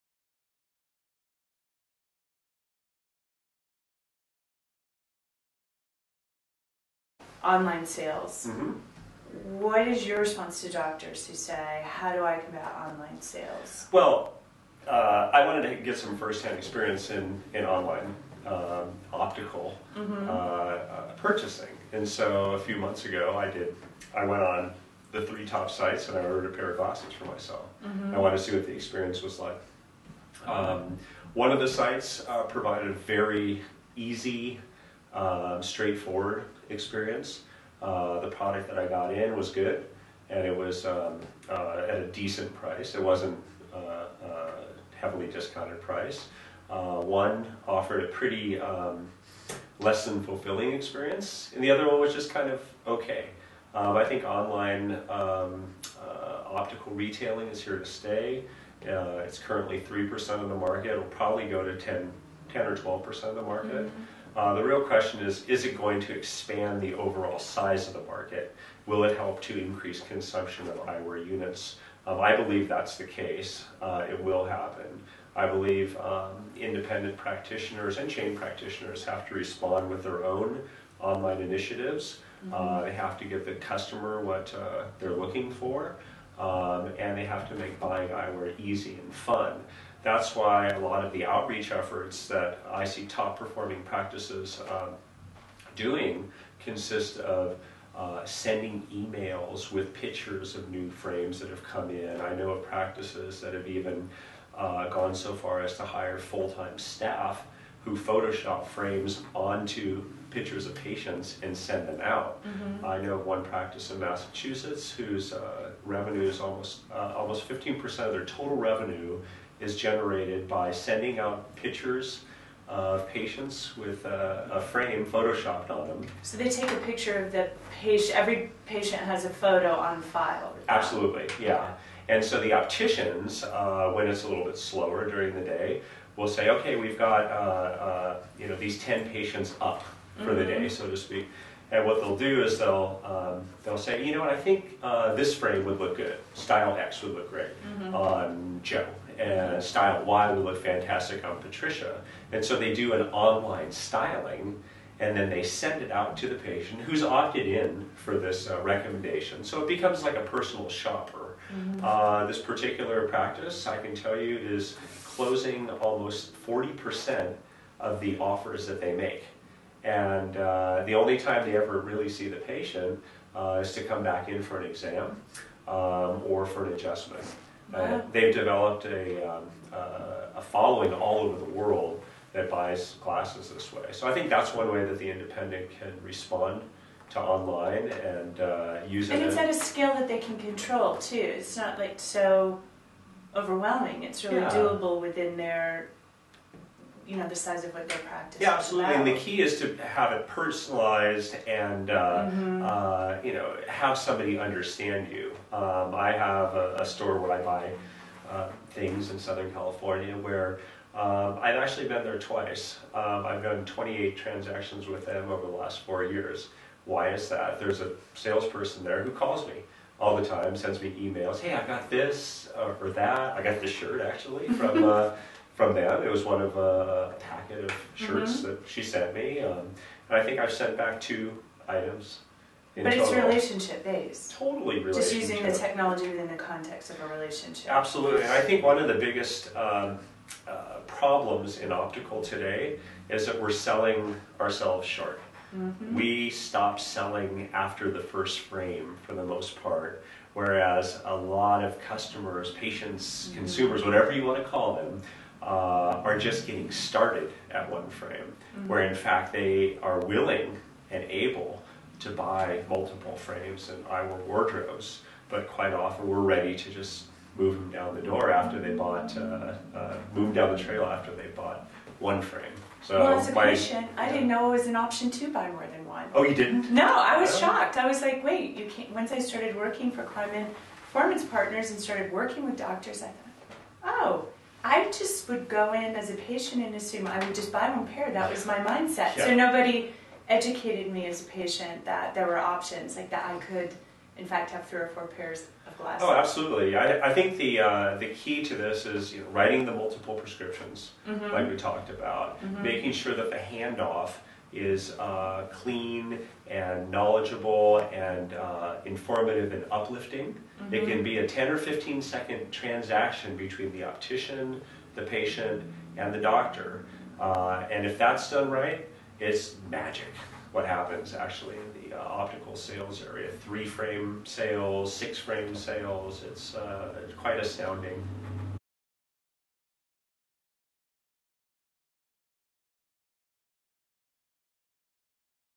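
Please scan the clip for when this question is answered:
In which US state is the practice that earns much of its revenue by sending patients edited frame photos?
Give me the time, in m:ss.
1:53.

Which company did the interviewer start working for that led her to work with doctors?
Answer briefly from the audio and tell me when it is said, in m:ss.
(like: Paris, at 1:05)
Cleinman Performance Partners, at 4:40.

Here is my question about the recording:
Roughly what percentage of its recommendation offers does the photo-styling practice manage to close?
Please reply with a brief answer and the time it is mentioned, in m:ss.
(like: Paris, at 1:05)
40%, at 2:46.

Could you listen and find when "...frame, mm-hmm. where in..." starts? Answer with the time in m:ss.
4:17.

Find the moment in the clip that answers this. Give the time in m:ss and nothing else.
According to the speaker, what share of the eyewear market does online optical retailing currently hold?
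0:59.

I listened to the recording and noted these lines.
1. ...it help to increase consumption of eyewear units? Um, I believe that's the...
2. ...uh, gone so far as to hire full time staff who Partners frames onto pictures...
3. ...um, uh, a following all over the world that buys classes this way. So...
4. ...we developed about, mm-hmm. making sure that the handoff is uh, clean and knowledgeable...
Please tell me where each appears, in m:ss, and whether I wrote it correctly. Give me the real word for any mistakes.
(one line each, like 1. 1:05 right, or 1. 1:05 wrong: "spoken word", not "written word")
1. 1:09 right
2. 1:44 wrong: "Photoshop", not "Partners"
3. 2:59 right
4. 5:01 wrong: "talked", not "developed".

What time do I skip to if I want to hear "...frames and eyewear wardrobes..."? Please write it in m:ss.
4:23.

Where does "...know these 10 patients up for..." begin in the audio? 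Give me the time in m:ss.
2:18.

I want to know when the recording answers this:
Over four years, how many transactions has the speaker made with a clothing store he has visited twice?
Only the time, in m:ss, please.
3:33.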